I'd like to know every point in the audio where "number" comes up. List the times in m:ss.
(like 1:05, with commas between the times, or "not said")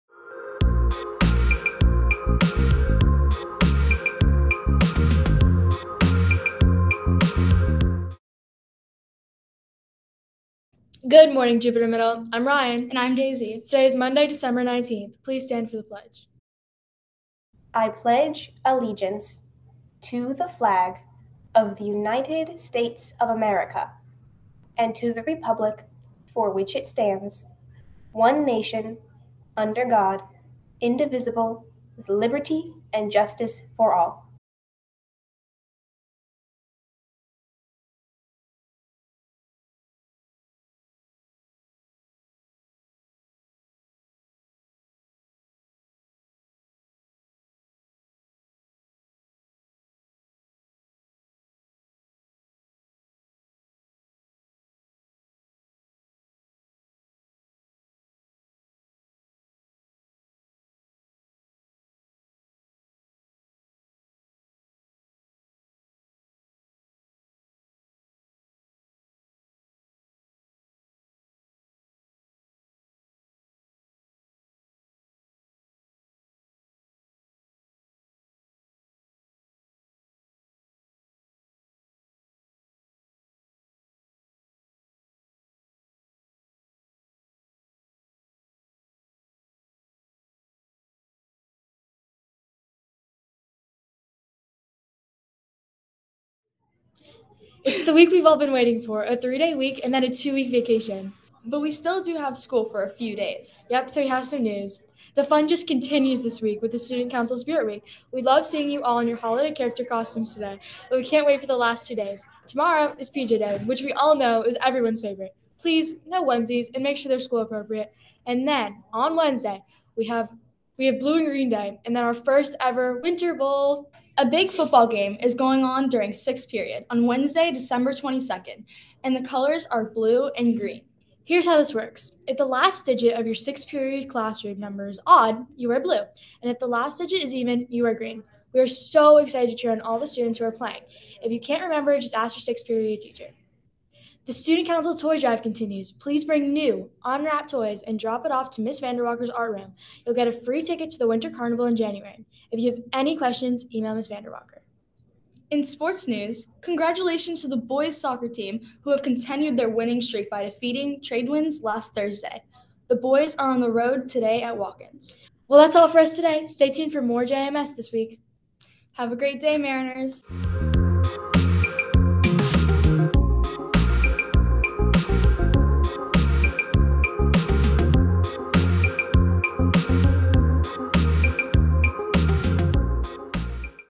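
2:14.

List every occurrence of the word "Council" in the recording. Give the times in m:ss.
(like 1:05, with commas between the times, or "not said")
1:47, 2:24.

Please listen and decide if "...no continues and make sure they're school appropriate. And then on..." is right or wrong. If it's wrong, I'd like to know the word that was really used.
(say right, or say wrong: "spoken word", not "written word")
wrong: "onesies", not "continues".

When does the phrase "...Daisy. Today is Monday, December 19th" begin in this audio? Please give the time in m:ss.
0:13.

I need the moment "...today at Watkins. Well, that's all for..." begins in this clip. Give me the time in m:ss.
2:44.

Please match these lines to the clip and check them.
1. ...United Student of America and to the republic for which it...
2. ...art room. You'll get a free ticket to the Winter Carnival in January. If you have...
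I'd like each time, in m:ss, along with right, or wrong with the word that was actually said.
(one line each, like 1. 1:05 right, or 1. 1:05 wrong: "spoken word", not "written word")
1. 0:21 wrong: "States", not "Student"
2. 2:29 right.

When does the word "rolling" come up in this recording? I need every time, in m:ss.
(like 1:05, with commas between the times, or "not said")
not said.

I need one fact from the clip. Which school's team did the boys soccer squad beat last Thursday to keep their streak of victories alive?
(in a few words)
Tradewinds.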